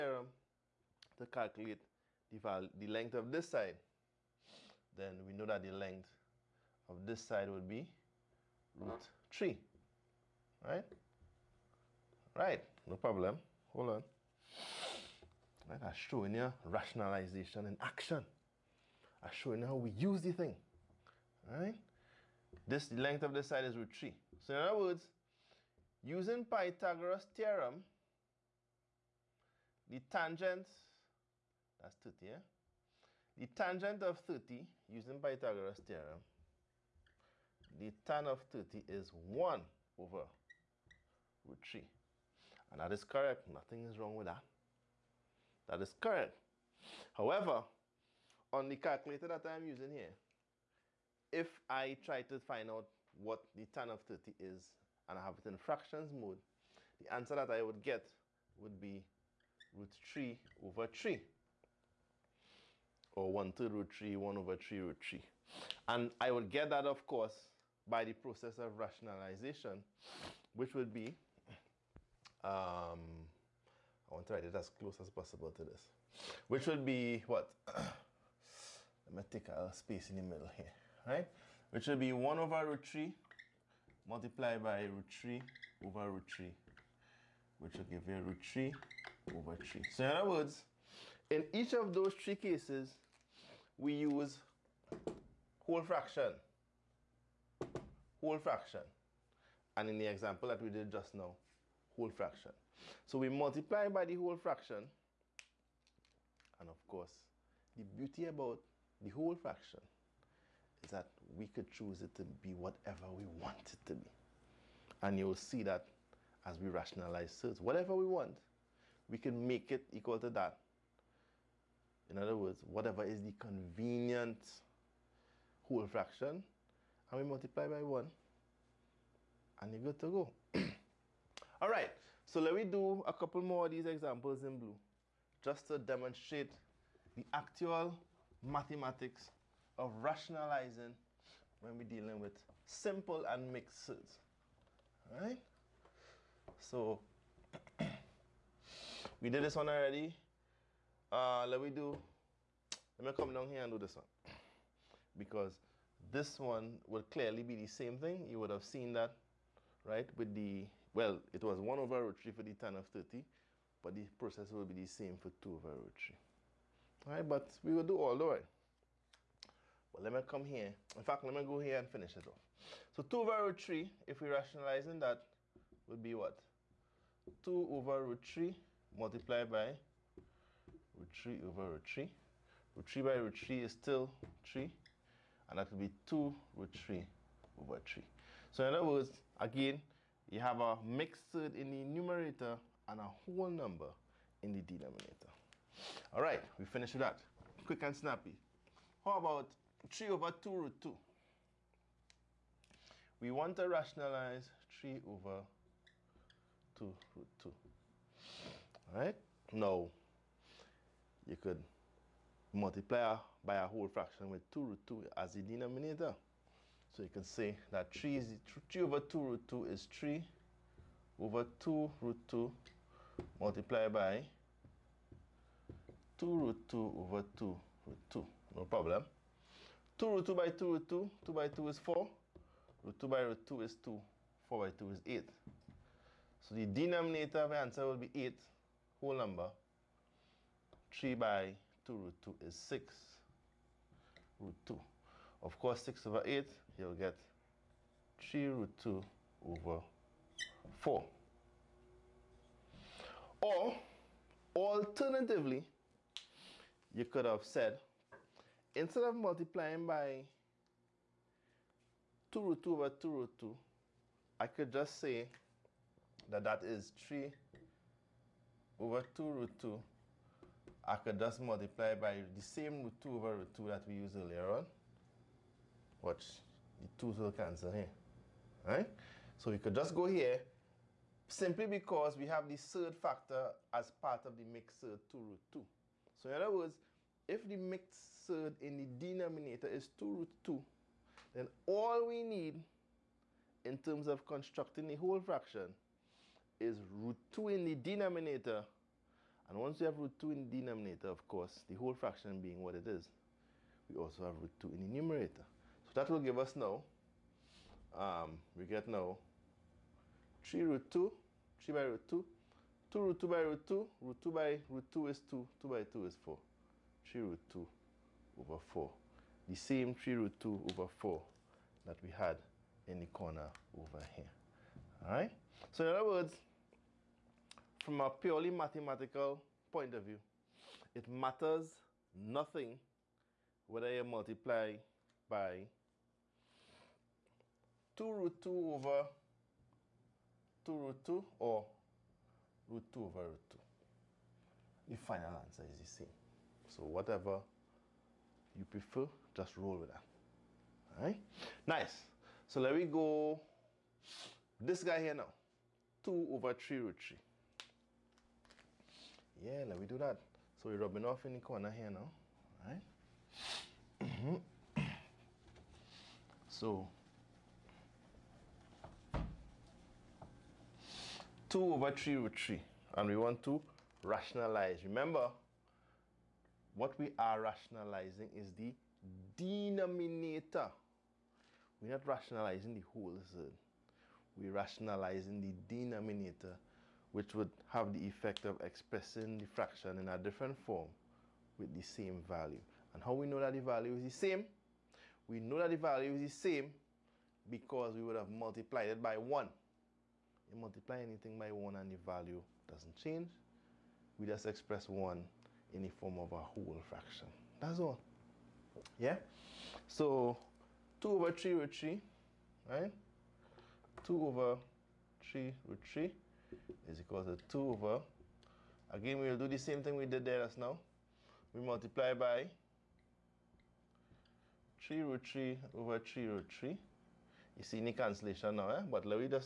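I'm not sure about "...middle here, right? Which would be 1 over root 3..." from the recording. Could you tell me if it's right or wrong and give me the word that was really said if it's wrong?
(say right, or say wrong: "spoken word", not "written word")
right.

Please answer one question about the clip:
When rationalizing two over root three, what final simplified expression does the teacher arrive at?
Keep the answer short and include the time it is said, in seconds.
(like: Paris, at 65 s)
2 root 3 over 3, at 186 s.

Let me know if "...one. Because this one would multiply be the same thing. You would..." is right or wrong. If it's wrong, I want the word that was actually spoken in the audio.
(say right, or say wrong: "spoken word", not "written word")
wrong: "clearly", not "multiply".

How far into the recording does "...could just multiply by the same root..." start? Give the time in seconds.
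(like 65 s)
270 s.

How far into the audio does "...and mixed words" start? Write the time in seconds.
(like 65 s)
143 s.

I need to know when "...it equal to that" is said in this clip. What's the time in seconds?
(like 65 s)
119 s.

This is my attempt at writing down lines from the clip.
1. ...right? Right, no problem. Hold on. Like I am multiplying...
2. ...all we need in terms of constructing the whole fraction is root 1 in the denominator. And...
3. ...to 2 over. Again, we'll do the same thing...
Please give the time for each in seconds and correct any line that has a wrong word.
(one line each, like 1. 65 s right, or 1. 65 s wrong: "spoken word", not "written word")
1. 10 s wrong: "showing", not "multiplying"
2. 291 s wrong: "2", not "1"
3. 417 s right.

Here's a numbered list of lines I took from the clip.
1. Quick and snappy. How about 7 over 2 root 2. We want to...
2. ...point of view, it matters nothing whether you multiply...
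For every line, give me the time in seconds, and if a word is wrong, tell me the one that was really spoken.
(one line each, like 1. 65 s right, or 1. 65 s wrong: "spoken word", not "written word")
1. 197 s wrong: "3", not "7"
2. 329 s right.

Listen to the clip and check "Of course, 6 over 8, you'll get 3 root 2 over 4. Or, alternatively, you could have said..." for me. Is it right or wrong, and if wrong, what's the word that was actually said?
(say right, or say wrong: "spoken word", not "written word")
right.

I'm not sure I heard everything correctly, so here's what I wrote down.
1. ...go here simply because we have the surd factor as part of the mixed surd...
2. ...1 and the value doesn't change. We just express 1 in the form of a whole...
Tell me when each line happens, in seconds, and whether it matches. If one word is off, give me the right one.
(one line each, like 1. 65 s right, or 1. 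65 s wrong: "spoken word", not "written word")
1. 279 s right
2. 401 s right.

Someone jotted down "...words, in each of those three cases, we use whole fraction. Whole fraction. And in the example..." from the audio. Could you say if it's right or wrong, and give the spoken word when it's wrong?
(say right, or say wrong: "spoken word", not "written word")
right.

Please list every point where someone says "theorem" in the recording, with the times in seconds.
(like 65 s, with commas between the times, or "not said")
27 s, 35 s.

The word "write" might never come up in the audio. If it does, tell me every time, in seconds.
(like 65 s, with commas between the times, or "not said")
74 s.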